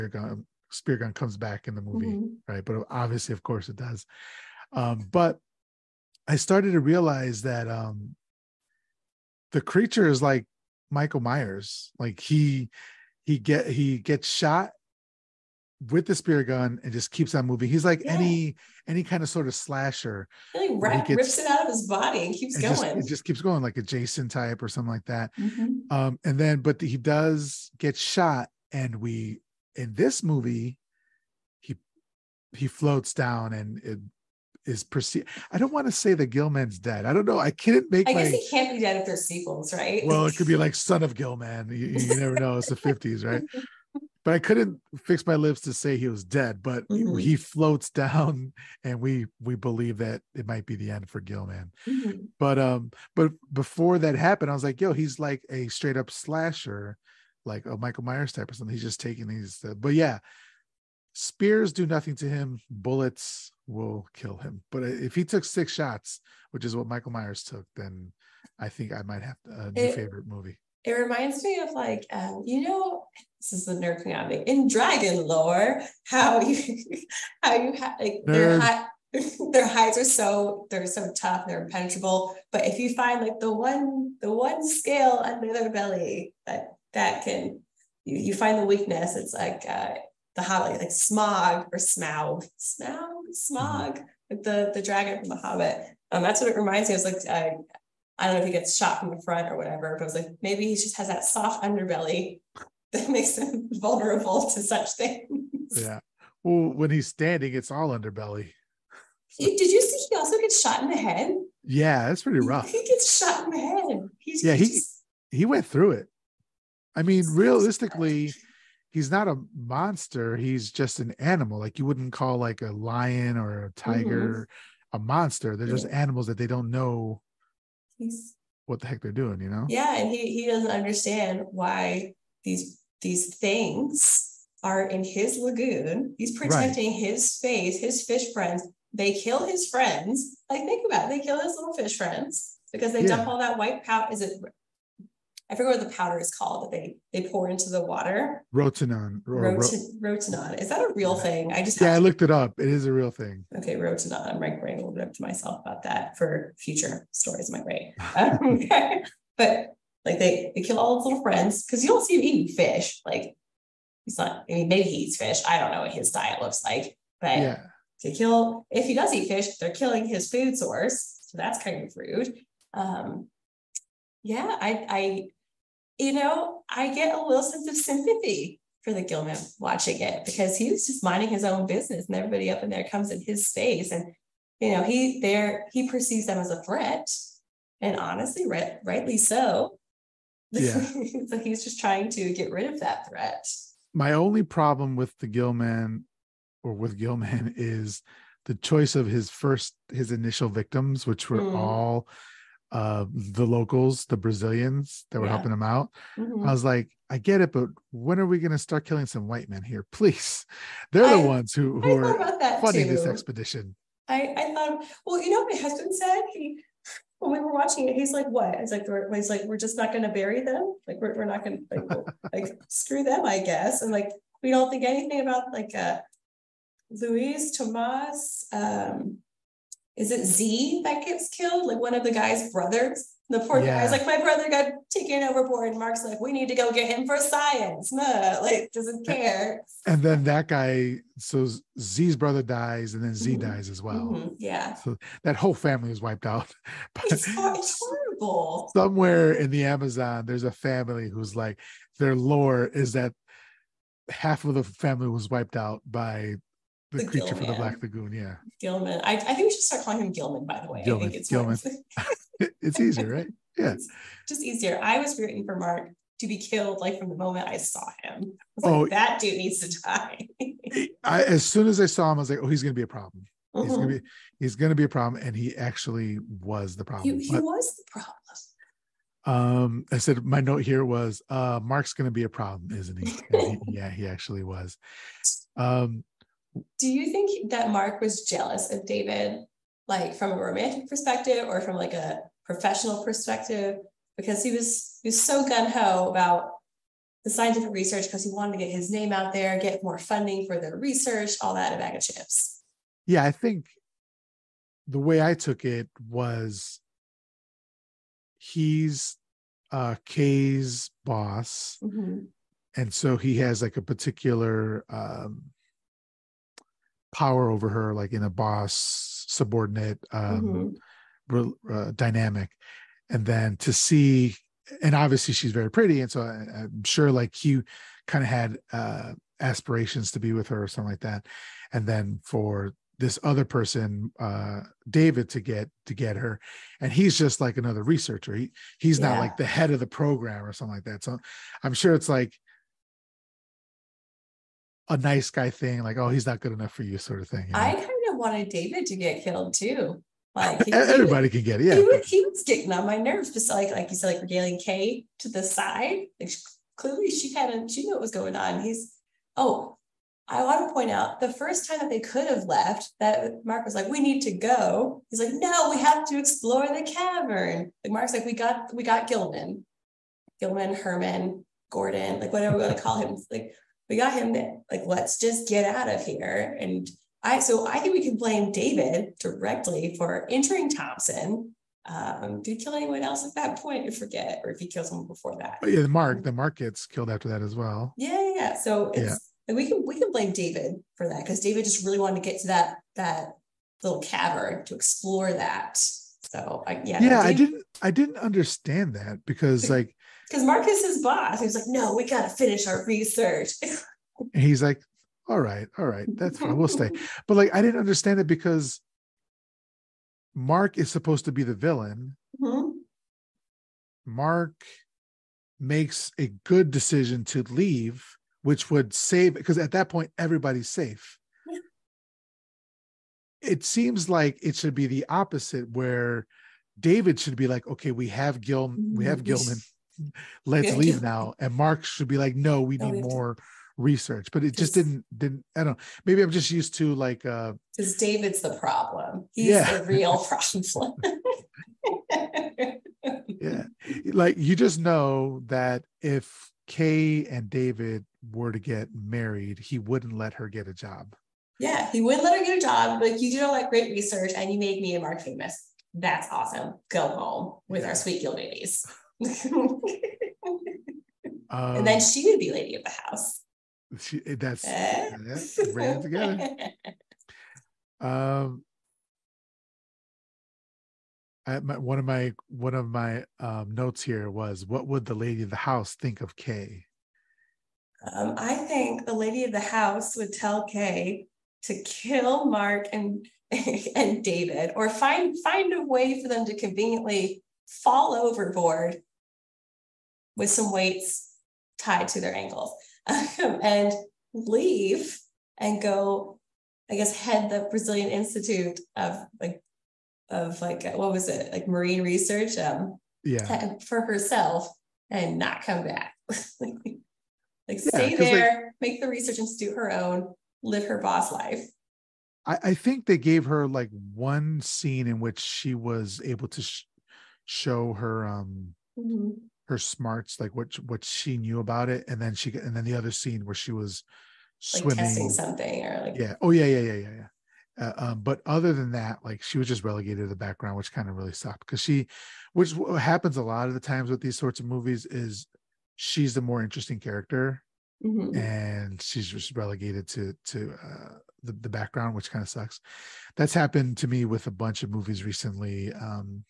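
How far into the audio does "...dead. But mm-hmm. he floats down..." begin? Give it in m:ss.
0:46.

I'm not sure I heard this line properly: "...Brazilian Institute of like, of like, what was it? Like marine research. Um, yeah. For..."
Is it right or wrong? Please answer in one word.
right.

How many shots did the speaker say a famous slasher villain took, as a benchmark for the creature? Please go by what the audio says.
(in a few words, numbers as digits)
6.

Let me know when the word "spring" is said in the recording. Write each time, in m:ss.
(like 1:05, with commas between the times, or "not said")
not said.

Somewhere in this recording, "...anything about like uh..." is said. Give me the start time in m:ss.
3:44.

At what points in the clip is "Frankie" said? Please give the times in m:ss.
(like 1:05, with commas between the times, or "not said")
not said.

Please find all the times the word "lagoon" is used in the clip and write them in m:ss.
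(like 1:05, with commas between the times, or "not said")
2:15, 4:17.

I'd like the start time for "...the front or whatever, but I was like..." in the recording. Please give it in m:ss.
1:39.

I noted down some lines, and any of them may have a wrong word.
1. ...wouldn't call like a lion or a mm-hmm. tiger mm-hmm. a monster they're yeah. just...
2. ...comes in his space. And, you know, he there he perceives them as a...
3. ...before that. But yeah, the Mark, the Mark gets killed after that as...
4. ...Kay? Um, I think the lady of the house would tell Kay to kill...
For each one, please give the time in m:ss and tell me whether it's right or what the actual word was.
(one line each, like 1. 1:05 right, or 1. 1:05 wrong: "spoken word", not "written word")
1. 2:01 right
2. 3:02 right
3. 6:25 right
4. 7:56 right.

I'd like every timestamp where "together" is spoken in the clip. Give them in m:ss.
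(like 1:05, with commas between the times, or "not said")
7:46.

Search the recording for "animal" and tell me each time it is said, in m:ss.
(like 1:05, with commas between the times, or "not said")
2:01, 2:05.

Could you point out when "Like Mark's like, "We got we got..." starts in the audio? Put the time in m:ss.
6:07.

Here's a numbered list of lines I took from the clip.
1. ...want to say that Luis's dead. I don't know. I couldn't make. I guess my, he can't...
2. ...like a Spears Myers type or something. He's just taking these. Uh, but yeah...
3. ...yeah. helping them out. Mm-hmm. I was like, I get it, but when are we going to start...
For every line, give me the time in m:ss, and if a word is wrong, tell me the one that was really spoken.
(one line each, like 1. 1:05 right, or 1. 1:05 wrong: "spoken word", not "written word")
1. 0:35 wrong: "Gilman", not "Luis"
2. 0:57 wrong: "Michael", not "Spears"
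3. 3:25 right.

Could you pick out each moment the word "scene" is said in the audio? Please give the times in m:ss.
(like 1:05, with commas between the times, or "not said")
8:34, 8:43.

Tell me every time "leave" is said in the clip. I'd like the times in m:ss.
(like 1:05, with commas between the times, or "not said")
6:57, 7:10, 8:14.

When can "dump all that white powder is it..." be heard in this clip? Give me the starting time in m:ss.
2:23.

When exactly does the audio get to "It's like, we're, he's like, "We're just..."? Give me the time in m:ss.
3:38.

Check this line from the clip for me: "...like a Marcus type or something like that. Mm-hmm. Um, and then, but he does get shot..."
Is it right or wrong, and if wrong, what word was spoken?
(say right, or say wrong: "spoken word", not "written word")
wrong: "Jason", not "Marcus".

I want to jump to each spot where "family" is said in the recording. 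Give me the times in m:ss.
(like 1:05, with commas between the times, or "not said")
4:05, 4:10, 4:14.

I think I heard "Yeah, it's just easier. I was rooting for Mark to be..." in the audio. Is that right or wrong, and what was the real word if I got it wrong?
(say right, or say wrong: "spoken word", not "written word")
right.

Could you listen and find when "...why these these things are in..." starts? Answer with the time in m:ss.
2:11.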